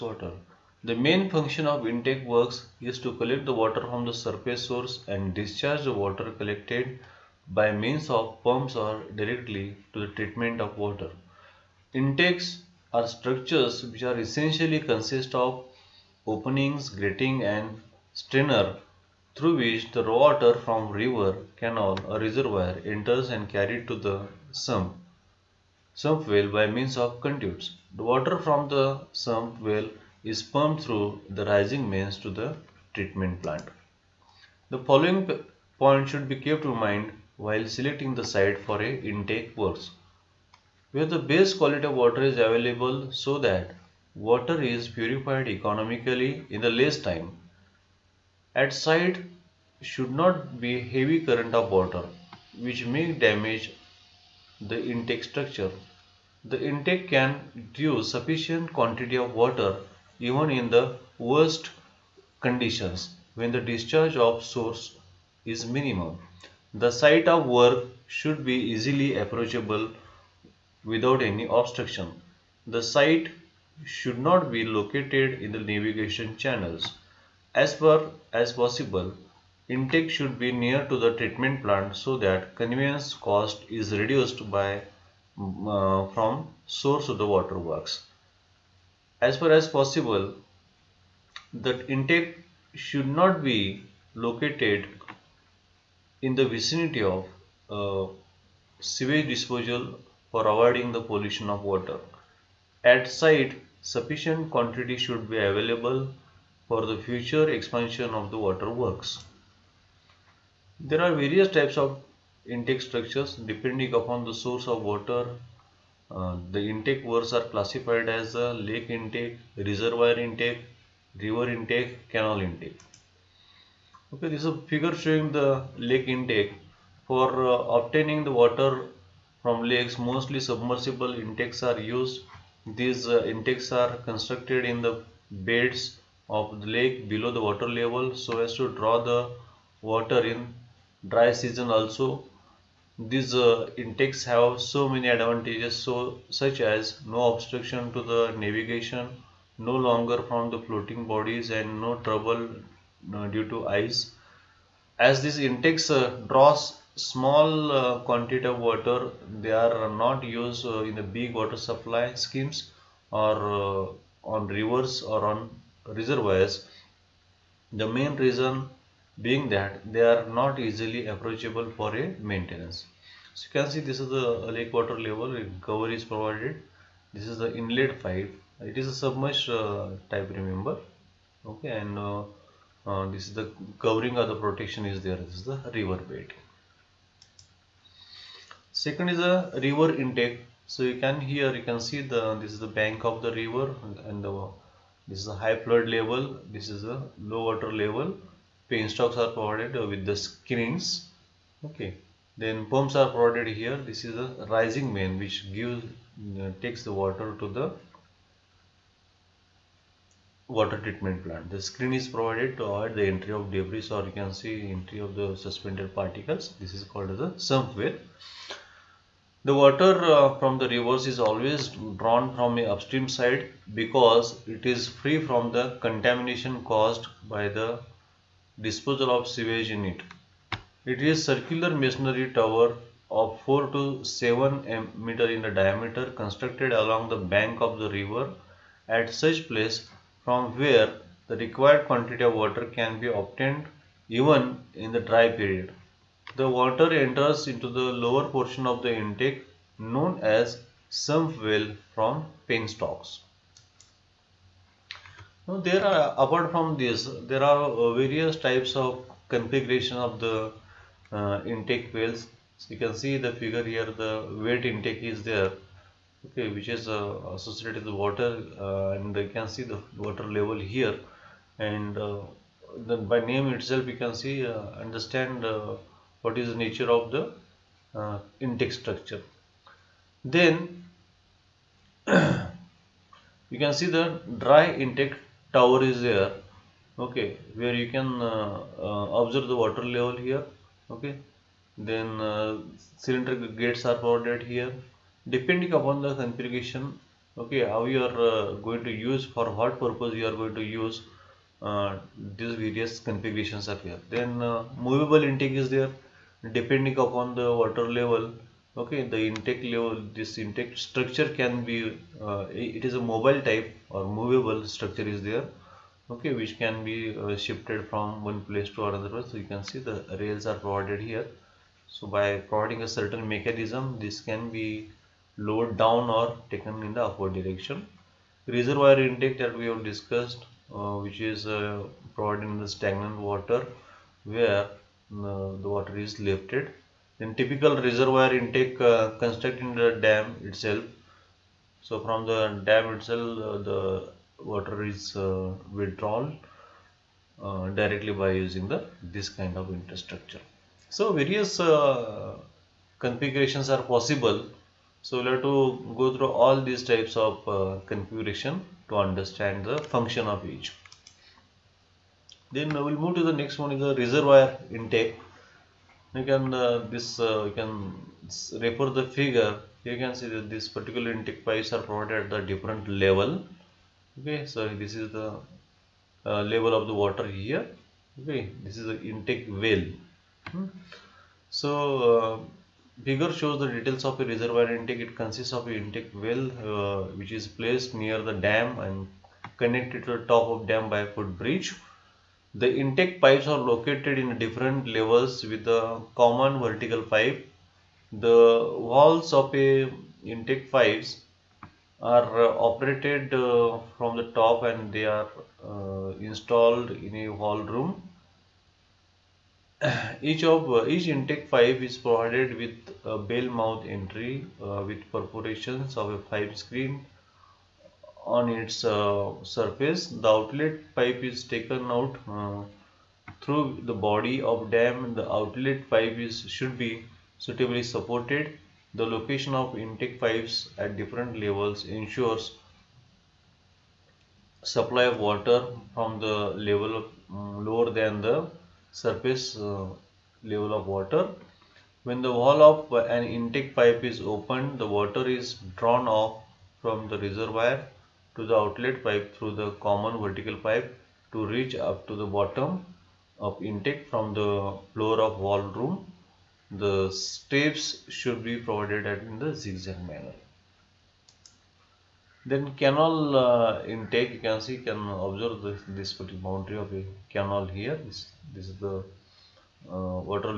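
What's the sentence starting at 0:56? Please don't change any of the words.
The intake can reduce sufficient quantity of water even in the worst conditions when the discharge of source is minimum.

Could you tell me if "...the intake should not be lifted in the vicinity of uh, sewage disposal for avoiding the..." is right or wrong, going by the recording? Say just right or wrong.
wrong.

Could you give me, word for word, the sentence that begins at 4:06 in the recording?
The water enters into the lower portion of the intake known as sump well from penstocks.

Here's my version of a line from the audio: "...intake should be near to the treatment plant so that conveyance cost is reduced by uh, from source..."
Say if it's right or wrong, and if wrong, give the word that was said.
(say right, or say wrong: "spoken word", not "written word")
right.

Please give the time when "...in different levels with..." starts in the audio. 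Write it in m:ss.
6:34.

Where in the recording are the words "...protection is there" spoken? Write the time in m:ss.
3:04.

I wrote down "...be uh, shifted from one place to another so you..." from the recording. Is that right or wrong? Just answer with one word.
right.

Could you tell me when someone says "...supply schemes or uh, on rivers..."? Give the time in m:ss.
2:41.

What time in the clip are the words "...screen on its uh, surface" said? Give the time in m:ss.
6:56.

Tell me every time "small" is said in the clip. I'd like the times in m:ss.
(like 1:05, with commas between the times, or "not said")
2:36.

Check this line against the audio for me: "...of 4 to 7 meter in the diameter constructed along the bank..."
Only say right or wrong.
right.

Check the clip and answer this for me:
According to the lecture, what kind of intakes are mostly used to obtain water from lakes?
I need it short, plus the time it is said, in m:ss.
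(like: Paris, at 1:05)
Submersible intakes, at 2:10.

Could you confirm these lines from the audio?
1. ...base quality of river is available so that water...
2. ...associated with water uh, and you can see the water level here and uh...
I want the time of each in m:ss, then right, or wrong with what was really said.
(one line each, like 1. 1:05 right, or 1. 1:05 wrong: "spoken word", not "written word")
1. 0:41 wrong: "water", not "river"
2. 4:27 right.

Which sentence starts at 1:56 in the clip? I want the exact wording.
Uh, the intake works are classified as lake intake, reservoir intake, river intake, canal intake.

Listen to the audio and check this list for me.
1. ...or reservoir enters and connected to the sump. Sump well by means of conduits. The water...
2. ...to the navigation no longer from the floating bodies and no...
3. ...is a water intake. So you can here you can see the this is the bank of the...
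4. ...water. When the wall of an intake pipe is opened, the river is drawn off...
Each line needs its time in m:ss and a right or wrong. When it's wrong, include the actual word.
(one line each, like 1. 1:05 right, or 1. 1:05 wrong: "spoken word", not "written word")
1. 0:22 wrong: "carried", not "connected"
2. 2:27 right
3. 3:09 wrong: "river", not "water"
4. 7:20 wrong: "water", not "river".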